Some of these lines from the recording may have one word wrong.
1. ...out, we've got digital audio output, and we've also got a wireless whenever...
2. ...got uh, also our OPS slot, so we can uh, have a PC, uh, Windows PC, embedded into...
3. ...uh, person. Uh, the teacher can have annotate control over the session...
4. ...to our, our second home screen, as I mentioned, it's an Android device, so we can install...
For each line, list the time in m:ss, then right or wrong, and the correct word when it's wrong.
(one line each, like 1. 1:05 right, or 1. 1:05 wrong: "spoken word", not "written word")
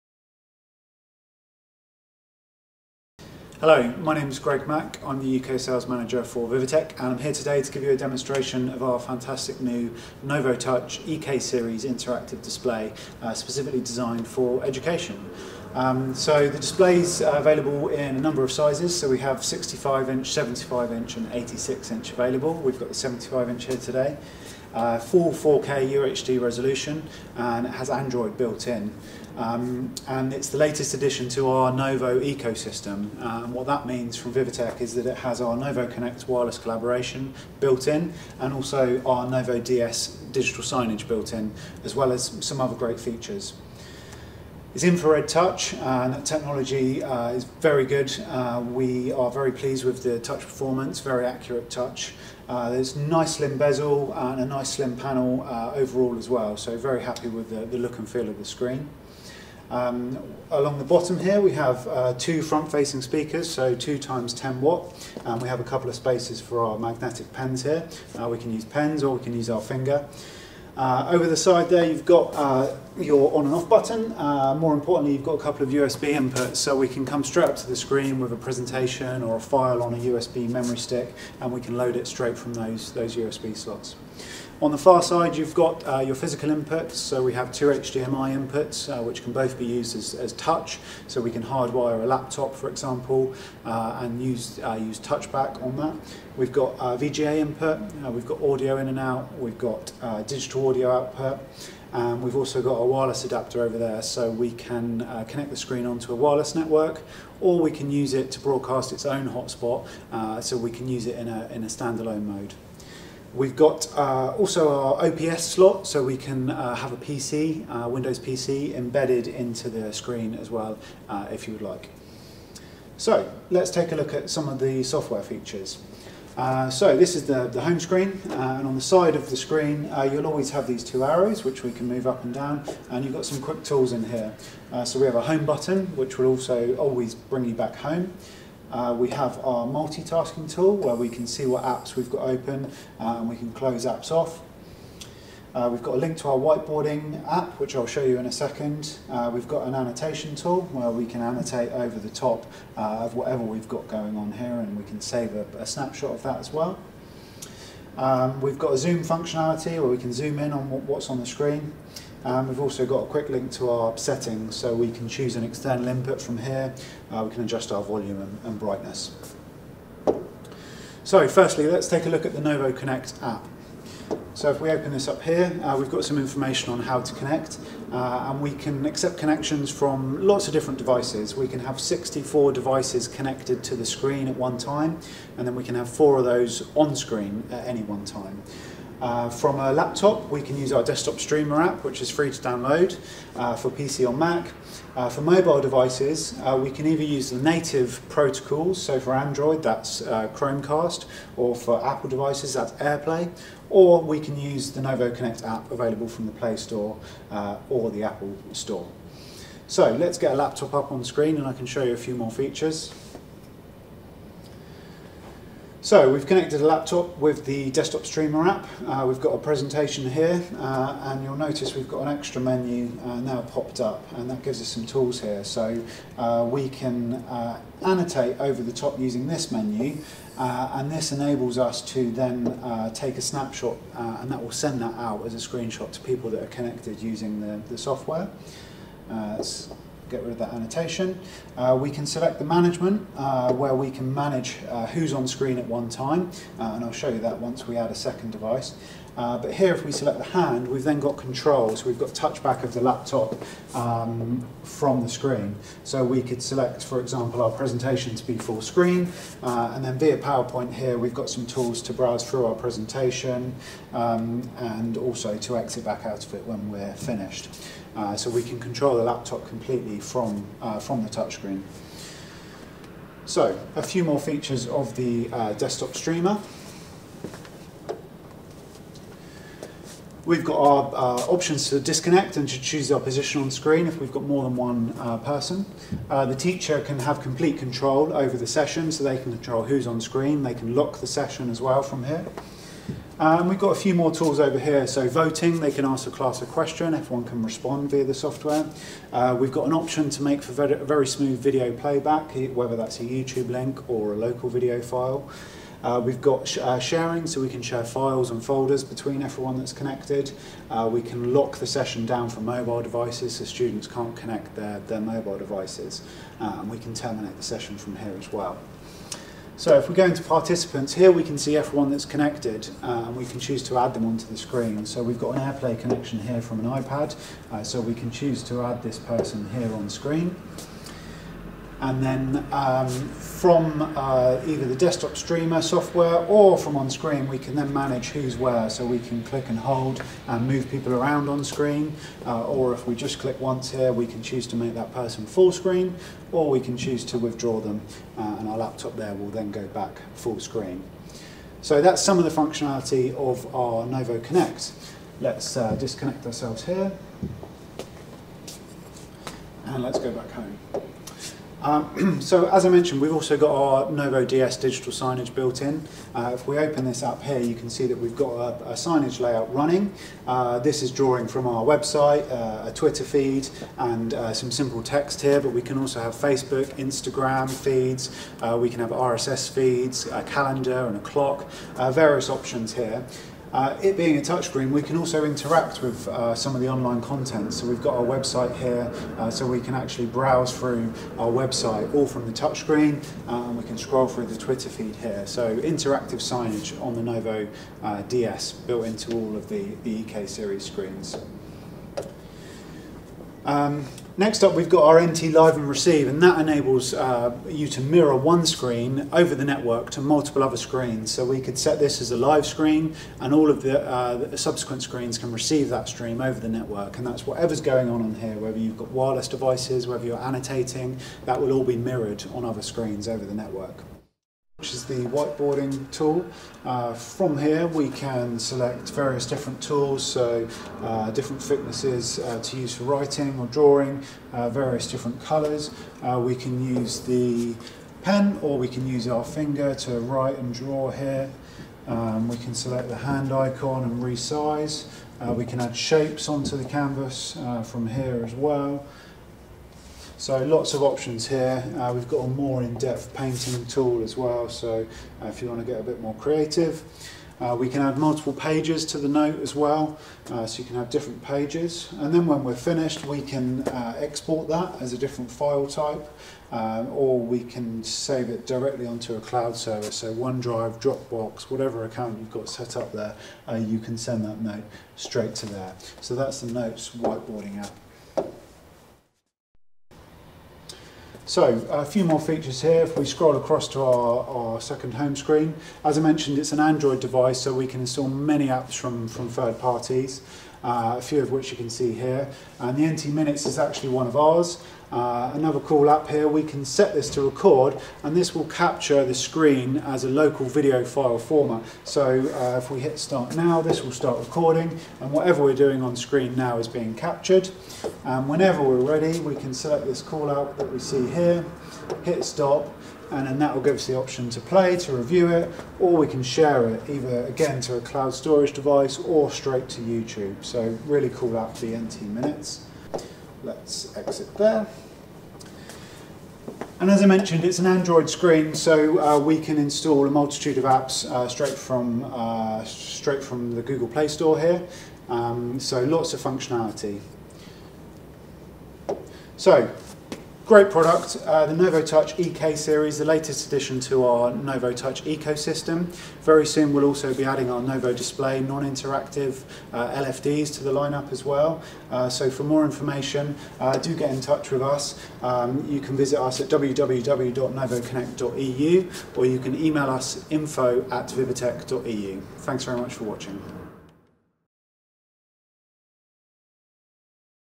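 1. 1:38 wrong: "adapter", not "whenever"
2. 1:53 right
3. 4:44 wrong: "complete", not "annotate"
4. 8:03 right.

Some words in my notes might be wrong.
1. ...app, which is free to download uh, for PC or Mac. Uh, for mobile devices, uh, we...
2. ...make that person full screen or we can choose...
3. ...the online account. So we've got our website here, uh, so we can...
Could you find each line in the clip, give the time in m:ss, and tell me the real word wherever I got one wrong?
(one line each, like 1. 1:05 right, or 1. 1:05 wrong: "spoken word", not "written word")
1. 3:11 right
2. 5:44 right
3. 6:26 wrong: "content", not "account".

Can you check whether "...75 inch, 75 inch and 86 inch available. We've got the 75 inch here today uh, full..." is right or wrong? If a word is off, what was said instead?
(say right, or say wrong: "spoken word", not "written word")
wrong: "65", not "75".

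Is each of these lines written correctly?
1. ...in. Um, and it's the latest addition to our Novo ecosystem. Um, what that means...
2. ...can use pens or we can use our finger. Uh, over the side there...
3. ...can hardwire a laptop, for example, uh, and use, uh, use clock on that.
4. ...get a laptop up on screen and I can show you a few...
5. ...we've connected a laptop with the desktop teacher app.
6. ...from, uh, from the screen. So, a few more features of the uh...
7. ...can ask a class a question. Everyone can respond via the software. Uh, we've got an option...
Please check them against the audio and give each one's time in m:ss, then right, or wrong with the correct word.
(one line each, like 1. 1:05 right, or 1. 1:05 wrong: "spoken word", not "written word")
1. 0:28 right
2. 1:08 right
3. 1:31 wrong: "touchback", not "clock"
4. 3:30 right
5. 3:36 wrong: "streamer", not "teacher"
6. 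4:30 wrong: "touchscreen", not "screen"
7. 4:55 right.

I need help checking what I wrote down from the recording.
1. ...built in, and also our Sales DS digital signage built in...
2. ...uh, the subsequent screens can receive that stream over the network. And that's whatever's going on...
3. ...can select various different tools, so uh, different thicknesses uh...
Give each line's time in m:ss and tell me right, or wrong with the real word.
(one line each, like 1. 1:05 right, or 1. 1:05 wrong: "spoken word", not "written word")
1. 0:37 wrong: "Novo", not "Sales"
2. 6:53 right
3. 7:07 right.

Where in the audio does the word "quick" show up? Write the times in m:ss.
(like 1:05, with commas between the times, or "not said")
2:13, 2:43.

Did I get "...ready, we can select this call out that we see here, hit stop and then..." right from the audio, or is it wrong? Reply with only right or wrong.
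right.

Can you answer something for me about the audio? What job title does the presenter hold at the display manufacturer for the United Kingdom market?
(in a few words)
UK Sales Manager.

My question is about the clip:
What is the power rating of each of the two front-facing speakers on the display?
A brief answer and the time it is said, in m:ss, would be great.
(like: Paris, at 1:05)
10 watt, at 1:03.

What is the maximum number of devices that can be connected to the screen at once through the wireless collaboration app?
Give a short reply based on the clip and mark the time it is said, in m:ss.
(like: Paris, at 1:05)
64, at 3:01.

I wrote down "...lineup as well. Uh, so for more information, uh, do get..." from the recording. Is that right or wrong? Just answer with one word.
right.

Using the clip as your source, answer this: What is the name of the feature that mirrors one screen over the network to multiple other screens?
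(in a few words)
NT Live and Receive.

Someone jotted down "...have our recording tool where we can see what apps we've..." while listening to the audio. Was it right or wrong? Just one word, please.
wrong.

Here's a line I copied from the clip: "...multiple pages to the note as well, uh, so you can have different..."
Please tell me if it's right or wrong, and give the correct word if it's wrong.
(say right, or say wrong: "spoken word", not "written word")
right.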